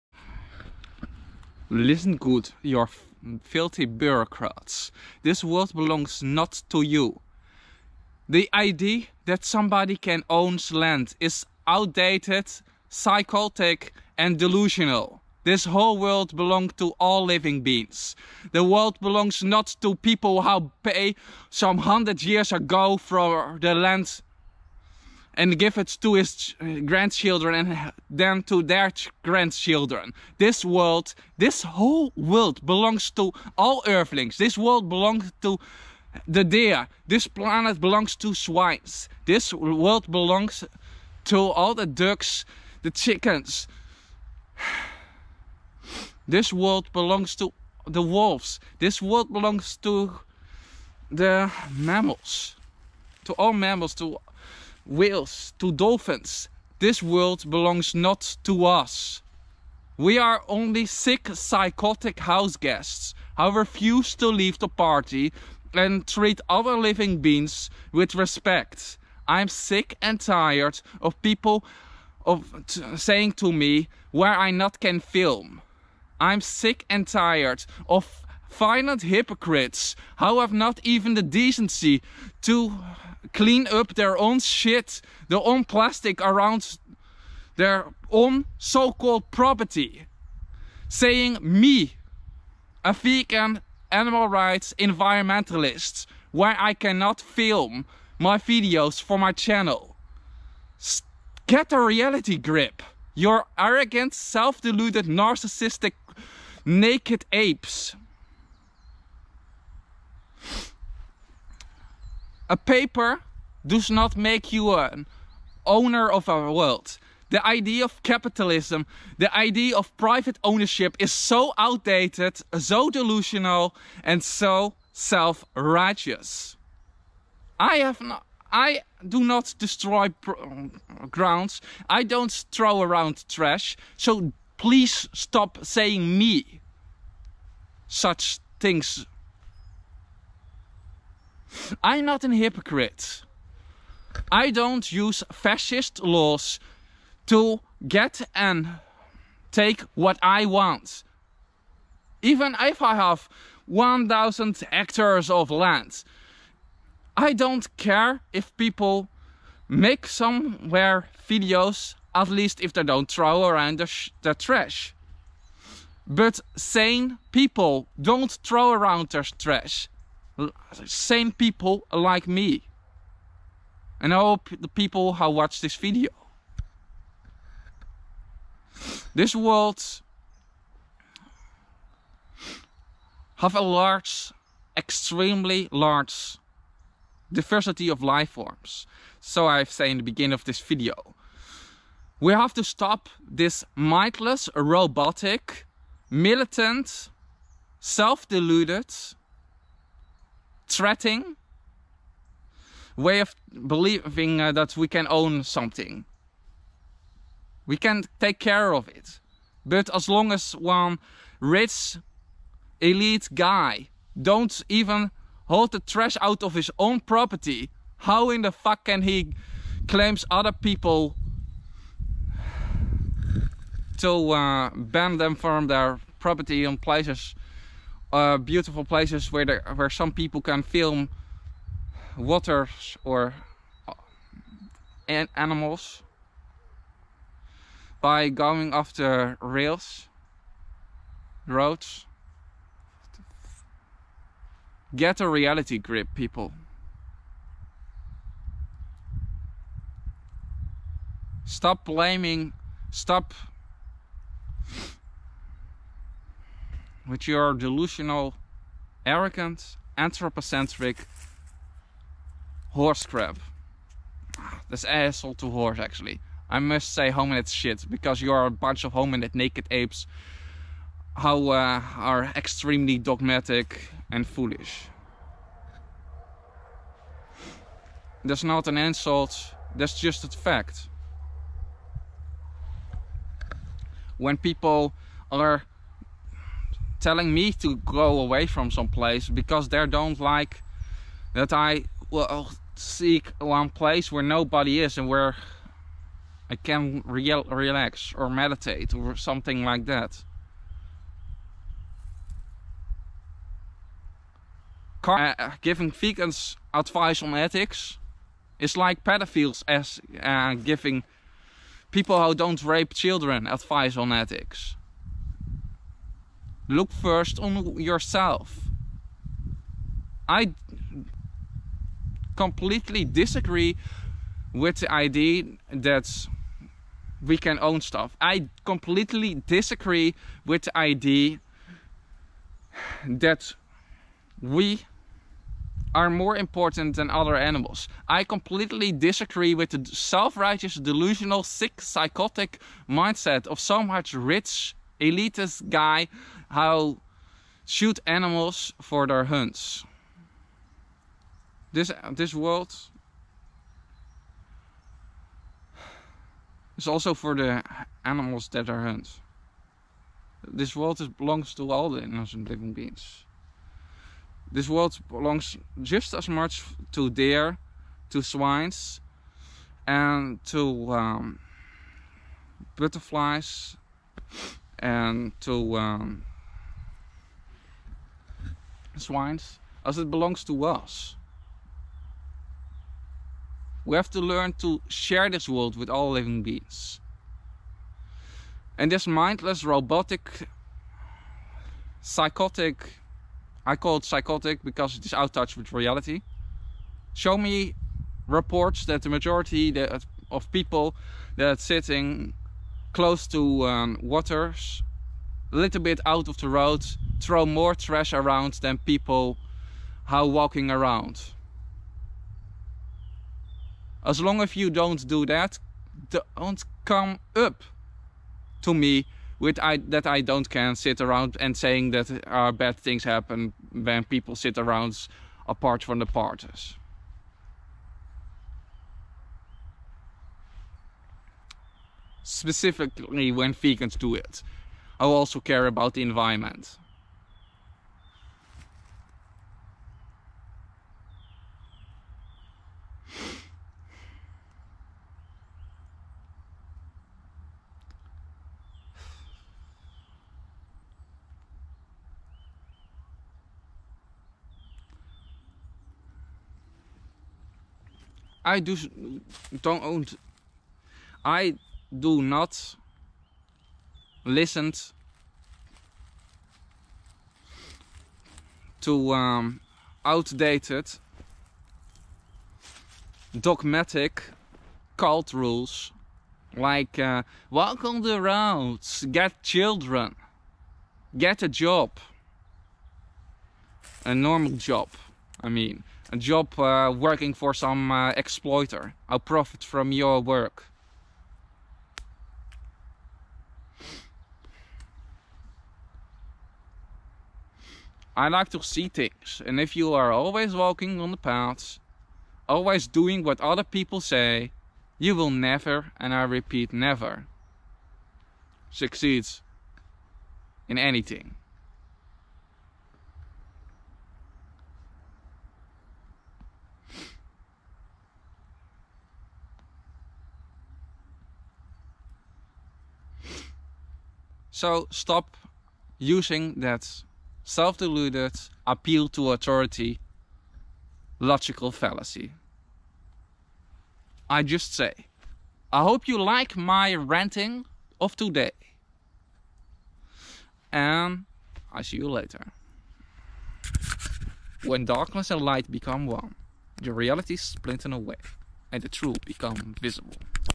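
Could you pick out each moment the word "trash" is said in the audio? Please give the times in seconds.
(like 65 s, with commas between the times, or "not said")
133 s, 164 s, 169 s, 215 s, 407 s.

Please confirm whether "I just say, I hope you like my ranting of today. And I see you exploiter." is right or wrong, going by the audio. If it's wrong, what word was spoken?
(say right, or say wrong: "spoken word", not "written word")
wrong: "later", not "exploiter".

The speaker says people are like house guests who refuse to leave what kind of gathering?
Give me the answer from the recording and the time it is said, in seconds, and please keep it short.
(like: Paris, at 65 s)
the party, at 64 s.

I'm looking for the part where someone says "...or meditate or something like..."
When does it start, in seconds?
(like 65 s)
298 s.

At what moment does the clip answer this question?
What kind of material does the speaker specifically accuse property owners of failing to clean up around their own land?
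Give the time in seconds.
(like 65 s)
85 s.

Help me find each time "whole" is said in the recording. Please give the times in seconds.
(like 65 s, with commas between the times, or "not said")
15 s, 31 s.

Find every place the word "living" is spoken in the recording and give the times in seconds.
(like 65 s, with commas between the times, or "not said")
17 s, 66 s, 362 s, 386 s.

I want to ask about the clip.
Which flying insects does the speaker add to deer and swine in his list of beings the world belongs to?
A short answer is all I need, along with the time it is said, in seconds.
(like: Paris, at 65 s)
butterflies, at 372 s.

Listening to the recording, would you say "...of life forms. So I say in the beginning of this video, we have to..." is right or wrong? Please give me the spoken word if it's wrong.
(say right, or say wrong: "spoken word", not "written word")
right.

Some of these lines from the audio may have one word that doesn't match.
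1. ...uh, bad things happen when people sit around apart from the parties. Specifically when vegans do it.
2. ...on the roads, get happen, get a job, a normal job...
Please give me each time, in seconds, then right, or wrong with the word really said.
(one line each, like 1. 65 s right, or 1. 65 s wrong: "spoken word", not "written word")
1. 422 s right
2. 477 s wrong: "children", not "happen".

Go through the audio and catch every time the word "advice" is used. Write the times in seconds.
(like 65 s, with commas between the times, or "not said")
306 s, 313 s.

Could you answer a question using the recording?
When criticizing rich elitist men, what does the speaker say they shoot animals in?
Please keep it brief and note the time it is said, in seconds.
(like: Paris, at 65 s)
hunts, at 349 s.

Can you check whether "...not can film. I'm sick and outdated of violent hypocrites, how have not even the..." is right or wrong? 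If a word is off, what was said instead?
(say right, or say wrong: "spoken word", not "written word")
wrong: "tired", not "outdated".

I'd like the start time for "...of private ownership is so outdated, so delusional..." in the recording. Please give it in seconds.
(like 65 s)
119 s.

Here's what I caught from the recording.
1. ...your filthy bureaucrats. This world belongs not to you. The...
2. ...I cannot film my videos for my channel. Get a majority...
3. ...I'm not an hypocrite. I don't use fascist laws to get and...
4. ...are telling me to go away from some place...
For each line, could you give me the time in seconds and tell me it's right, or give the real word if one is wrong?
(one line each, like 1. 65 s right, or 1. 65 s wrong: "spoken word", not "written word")
1. 2 s right
2. 96 s wrong: "reality", not "majority"
3. 141 s right
4. 285 s right.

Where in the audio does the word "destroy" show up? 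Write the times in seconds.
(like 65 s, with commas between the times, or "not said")
129 s.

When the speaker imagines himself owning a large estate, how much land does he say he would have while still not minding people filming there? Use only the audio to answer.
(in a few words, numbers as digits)
1000 hectares.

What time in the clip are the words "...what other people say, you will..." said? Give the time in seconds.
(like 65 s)
503 s.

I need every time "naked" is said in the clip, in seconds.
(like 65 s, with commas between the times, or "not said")
106 s, 269 s.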